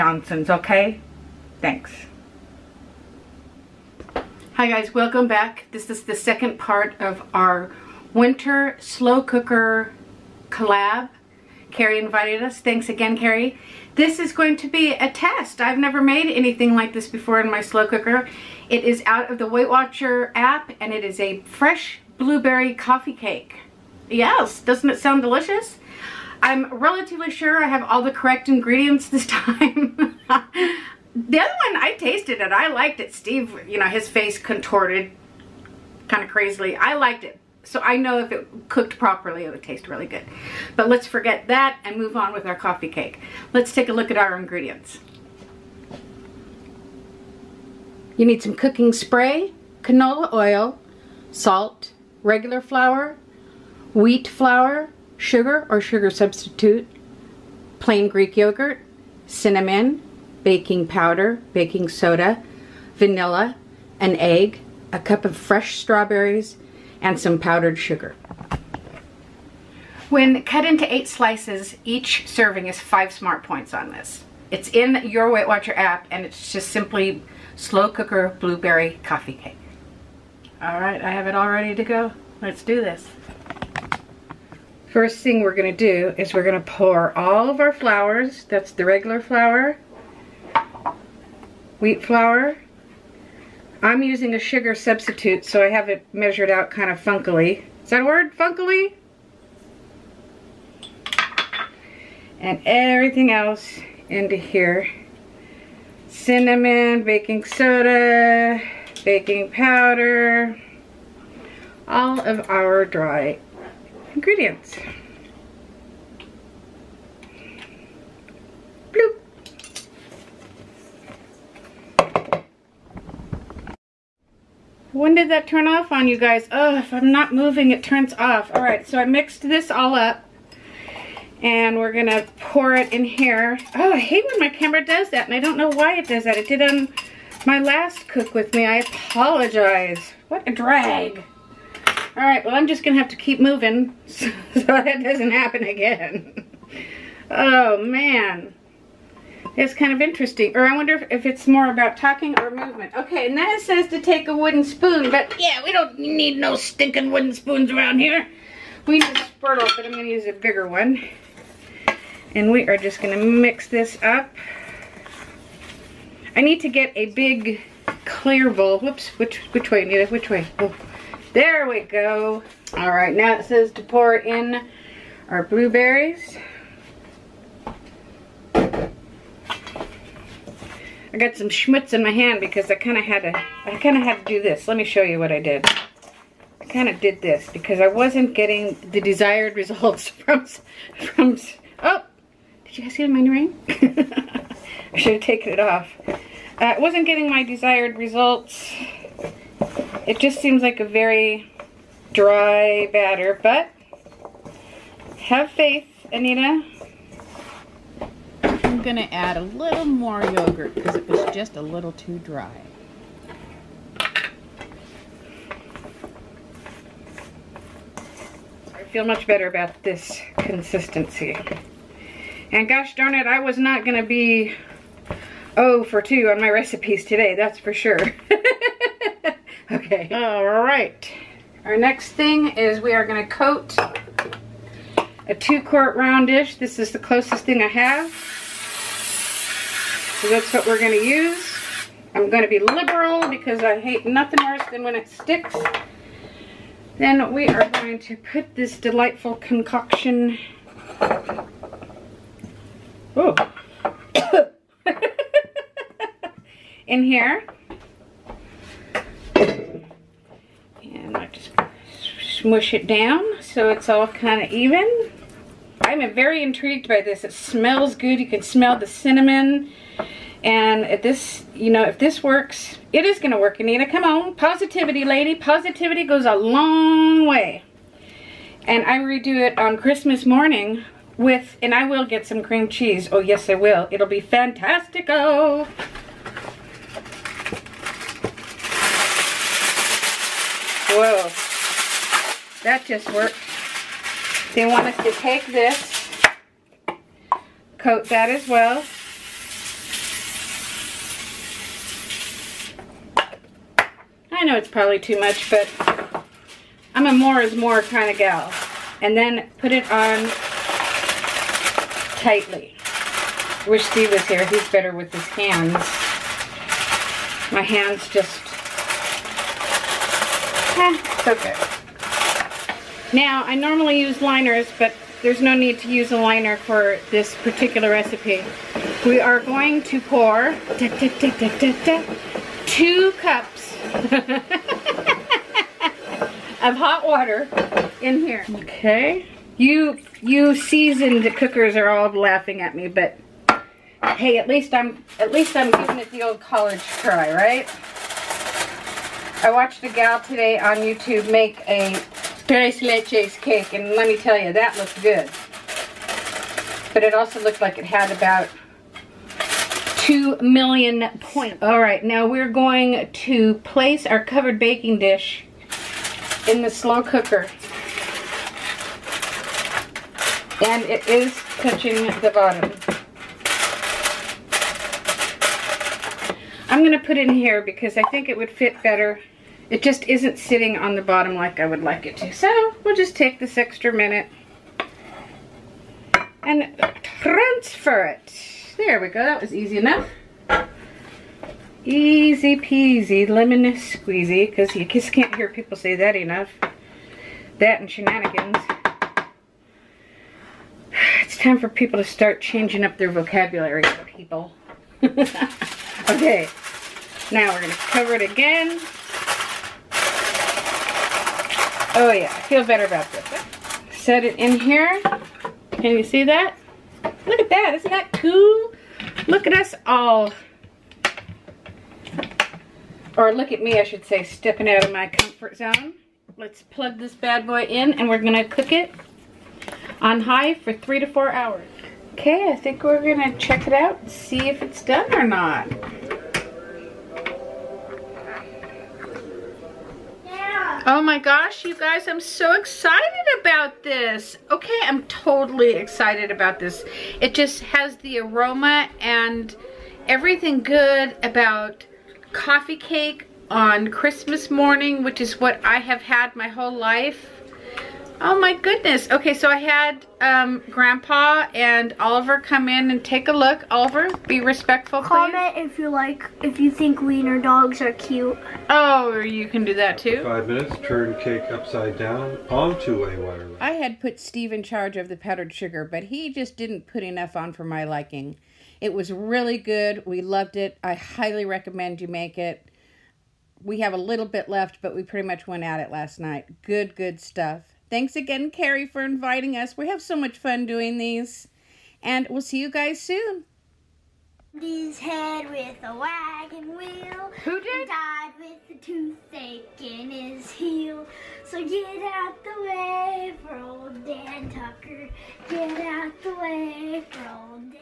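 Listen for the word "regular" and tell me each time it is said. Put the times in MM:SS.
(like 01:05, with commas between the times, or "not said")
00:52, 01:28.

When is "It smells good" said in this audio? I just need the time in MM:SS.
04:27.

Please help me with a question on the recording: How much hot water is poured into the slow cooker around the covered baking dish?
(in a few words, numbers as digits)
2 cups.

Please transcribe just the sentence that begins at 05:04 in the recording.
I know it's probably too much, but I'm a more is more kind of gal.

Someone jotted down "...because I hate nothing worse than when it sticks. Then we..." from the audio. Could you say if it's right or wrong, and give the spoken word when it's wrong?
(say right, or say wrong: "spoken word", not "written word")
right.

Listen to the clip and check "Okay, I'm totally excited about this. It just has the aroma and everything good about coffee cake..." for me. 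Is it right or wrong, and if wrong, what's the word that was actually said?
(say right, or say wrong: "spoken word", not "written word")
right.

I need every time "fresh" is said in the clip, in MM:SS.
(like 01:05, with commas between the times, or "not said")
00:21, 01:05.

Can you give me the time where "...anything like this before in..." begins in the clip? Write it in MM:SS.
00:16.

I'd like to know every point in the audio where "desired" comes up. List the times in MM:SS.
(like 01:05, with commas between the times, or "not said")
03:09, 03:17.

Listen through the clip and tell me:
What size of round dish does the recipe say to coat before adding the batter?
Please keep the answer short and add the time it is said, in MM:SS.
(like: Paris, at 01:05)
2 quart, at 03:55.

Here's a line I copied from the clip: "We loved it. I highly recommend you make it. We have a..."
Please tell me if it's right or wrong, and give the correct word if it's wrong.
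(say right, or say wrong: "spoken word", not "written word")
right.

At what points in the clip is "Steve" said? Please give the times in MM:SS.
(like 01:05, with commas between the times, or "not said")
00:33, 05:13, 07:54.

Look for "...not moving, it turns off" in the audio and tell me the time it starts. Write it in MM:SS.
02:07.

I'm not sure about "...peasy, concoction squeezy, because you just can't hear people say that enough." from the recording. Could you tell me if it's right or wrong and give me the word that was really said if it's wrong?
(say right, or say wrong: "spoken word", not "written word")
wrong: "lemon", not "concoction".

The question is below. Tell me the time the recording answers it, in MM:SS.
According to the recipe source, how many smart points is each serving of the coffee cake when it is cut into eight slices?
01:12.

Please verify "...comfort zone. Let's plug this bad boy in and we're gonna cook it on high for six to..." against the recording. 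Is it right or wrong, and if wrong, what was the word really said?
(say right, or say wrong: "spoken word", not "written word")
wrong: "three", not "six".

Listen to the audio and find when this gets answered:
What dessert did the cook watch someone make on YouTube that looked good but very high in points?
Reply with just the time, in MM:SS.
05:52.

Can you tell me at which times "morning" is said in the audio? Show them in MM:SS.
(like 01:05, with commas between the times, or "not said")
04:40, 07:34.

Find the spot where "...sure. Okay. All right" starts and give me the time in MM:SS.
03:47.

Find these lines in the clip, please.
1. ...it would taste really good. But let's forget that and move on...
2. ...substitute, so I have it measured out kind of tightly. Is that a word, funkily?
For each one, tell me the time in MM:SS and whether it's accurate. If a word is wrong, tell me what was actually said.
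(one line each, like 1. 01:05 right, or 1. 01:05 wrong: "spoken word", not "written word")
1. 00:39 right
2. 01:34 wrong: "funkily", not "tightly".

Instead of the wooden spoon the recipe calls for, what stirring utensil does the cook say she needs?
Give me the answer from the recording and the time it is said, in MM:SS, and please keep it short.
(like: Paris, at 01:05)
spurtle, at 02:39.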